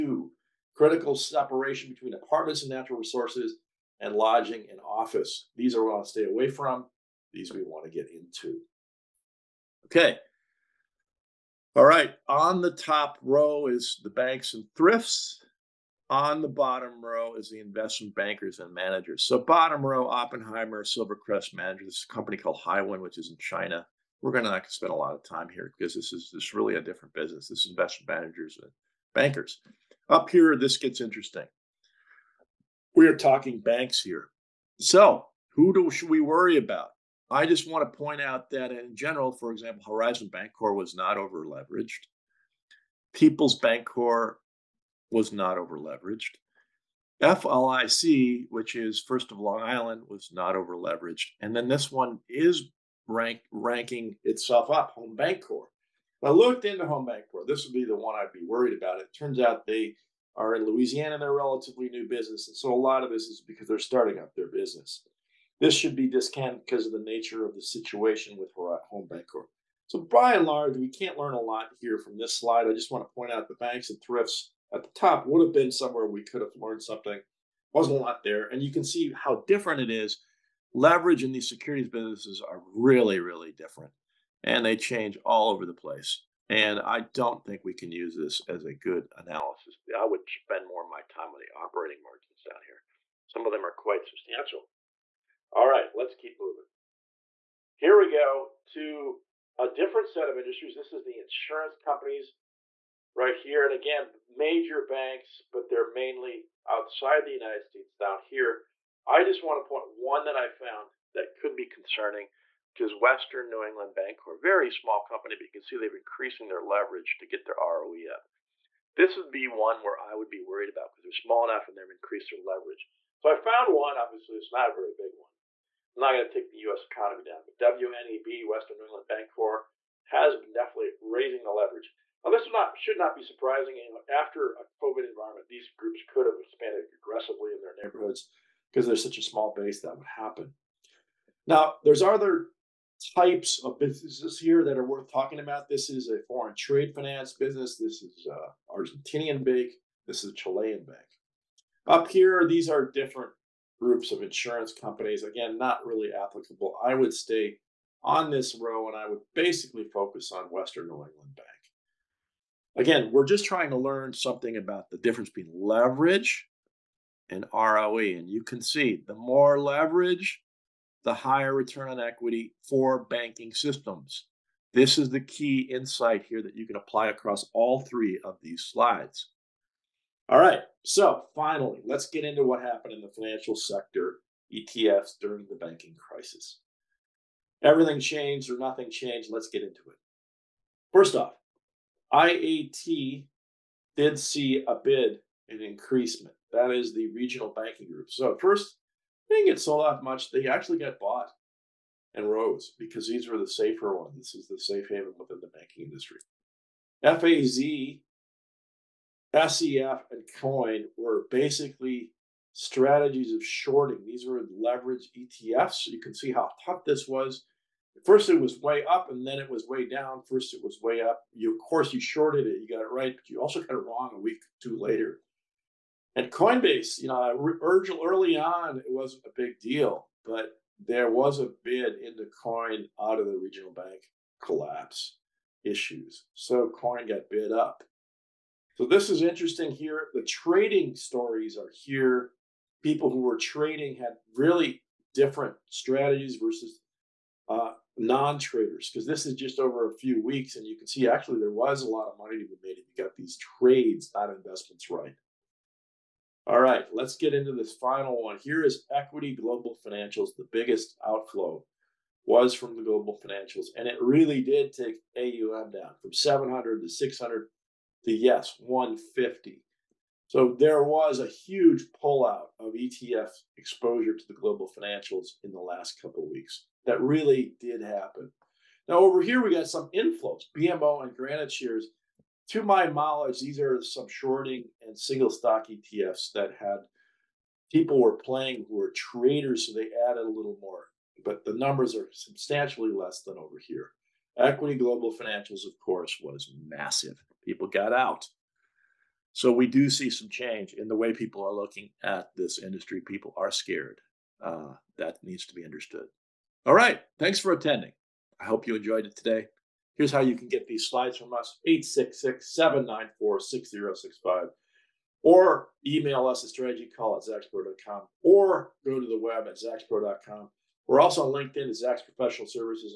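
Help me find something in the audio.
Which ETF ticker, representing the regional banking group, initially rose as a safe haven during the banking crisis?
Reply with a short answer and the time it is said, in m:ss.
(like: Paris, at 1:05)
IAT, at 3:12.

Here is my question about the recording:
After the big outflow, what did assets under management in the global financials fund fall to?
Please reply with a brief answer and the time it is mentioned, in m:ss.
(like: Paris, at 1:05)
150, at 4:28.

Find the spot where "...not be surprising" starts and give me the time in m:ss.
2:12.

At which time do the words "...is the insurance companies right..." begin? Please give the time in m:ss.
1:40.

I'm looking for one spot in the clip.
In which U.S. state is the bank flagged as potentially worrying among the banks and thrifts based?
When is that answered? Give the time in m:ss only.
1:00.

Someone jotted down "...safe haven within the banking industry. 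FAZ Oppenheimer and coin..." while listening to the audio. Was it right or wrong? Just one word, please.
wrong.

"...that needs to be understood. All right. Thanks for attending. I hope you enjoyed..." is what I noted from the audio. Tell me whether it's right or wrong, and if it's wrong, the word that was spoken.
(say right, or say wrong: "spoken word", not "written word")
right.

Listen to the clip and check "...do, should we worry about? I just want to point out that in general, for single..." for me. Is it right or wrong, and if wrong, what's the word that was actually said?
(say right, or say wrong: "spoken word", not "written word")
wrong: "example", not "single".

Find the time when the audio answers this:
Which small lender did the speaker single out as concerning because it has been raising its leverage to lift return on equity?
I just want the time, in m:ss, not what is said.
2:08.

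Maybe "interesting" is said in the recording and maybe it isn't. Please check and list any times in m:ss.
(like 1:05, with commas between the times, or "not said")
0:30, 3:59.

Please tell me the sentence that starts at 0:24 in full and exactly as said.
We're going to not spend a lot of time here because this is this really a different business.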